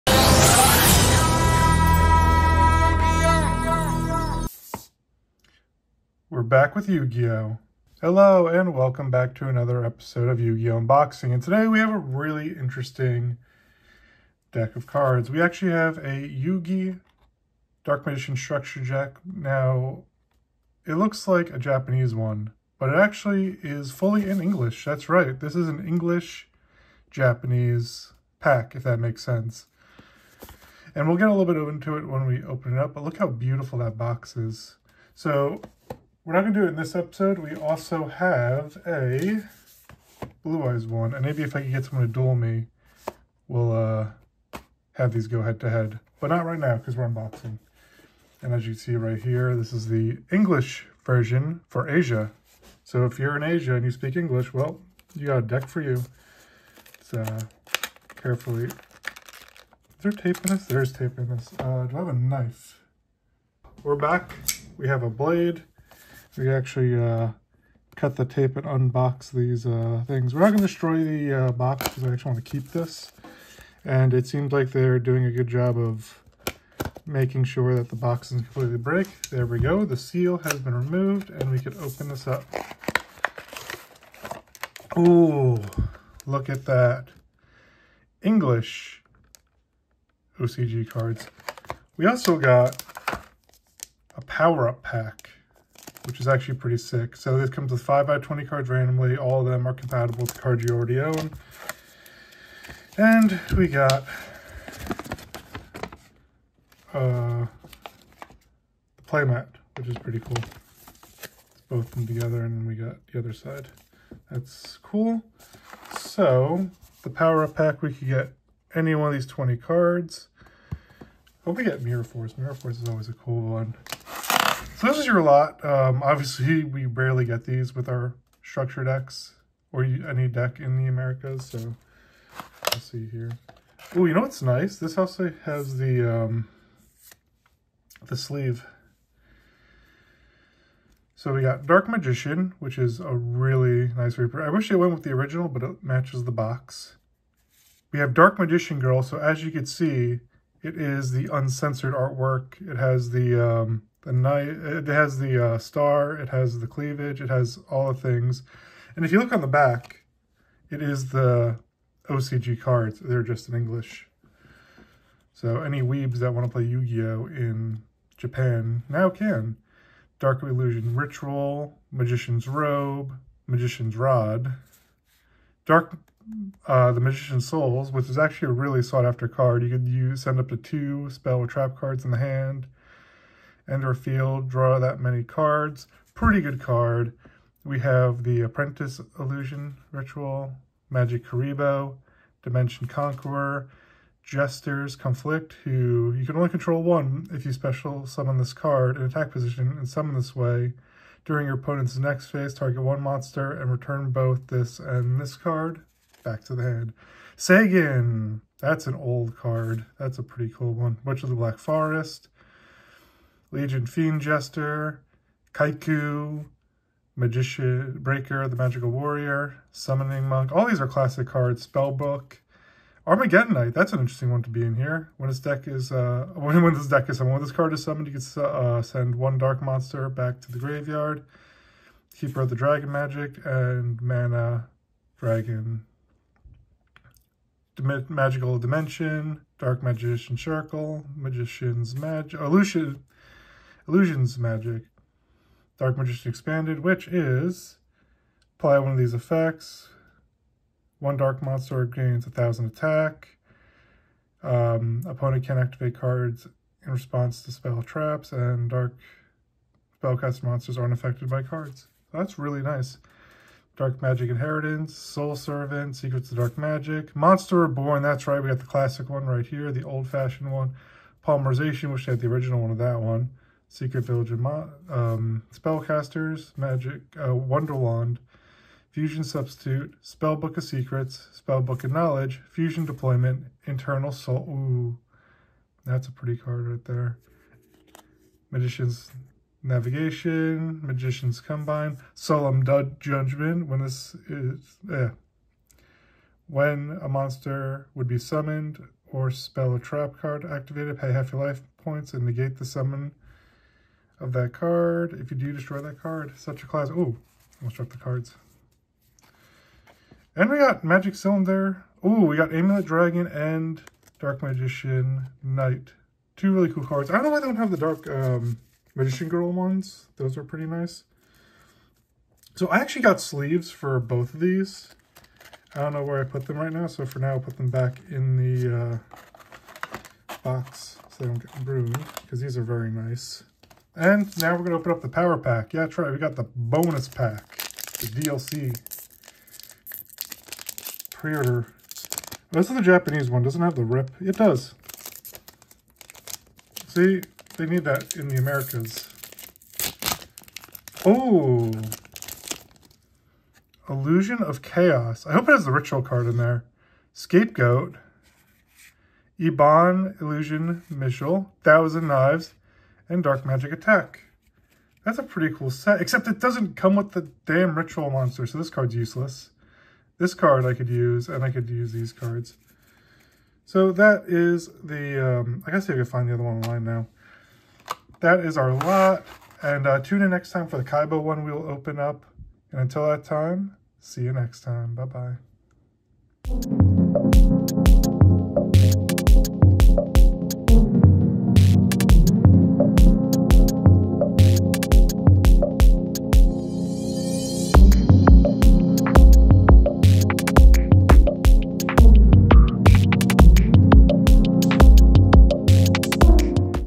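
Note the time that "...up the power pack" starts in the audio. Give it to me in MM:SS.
05:34.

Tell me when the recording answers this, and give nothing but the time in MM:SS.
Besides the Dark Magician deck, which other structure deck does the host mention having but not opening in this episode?
00:40.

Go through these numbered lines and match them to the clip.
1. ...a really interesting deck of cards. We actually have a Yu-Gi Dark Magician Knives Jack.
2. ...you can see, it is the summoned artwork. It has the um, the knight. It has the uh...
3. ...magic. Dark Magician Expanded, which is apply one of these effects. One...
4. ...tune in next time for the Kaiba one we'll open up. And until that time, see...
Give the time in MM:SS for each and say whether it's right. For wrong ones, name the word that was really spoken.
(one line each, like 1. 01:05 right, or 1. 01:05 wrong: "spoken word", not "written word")
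1. 00:11 wrong: "Structure", not "Knives"
2. 02:29 wrong: "uncensored", not "summoned"
3. 04:04 right
4. 06:20 right.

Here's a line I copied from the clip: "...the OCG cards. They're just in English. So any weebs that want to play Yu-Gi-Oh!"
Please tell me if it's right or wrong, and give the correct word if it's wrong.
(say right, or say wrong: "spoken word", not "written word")
right.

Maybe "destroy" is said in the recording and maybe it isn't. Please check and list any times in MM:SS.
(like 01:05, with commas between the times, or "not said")
01:10, 05:05.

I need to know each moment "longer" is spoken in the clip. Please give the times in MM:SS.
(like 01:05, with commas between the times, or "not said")
not said.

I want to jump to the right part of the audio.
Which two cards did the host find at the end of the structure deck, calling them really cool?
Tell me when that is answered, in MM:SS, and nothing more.
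05:12.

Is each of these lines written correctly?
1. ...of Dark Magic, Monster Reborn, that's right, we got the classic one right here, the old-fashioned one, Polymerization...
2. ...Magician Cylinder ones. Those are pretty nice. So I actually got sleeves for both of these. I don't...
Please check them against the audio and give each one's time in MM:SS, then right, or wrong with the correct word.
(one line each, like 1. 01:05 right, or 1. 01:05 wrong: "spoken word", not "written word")
1. 04:26 right
2. 05:18 wrong: "Girl", not "Cylinder".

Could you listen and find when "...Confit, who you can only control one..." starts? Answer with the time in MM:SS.
03:14.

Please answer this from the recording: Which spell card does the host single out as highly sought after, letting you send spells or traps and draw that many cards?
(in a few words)
Magician's Souls.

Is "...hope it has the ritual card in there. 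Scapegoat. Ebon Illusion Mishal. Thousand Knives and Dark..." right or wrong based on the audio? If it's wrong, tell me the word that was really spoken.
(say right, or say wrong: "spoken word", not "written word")
right.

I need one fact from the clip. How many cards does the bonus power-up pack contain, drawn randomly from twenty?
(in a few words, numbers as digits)
5.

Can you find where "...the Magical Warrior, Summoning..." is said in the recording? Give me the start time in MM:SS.
03:38.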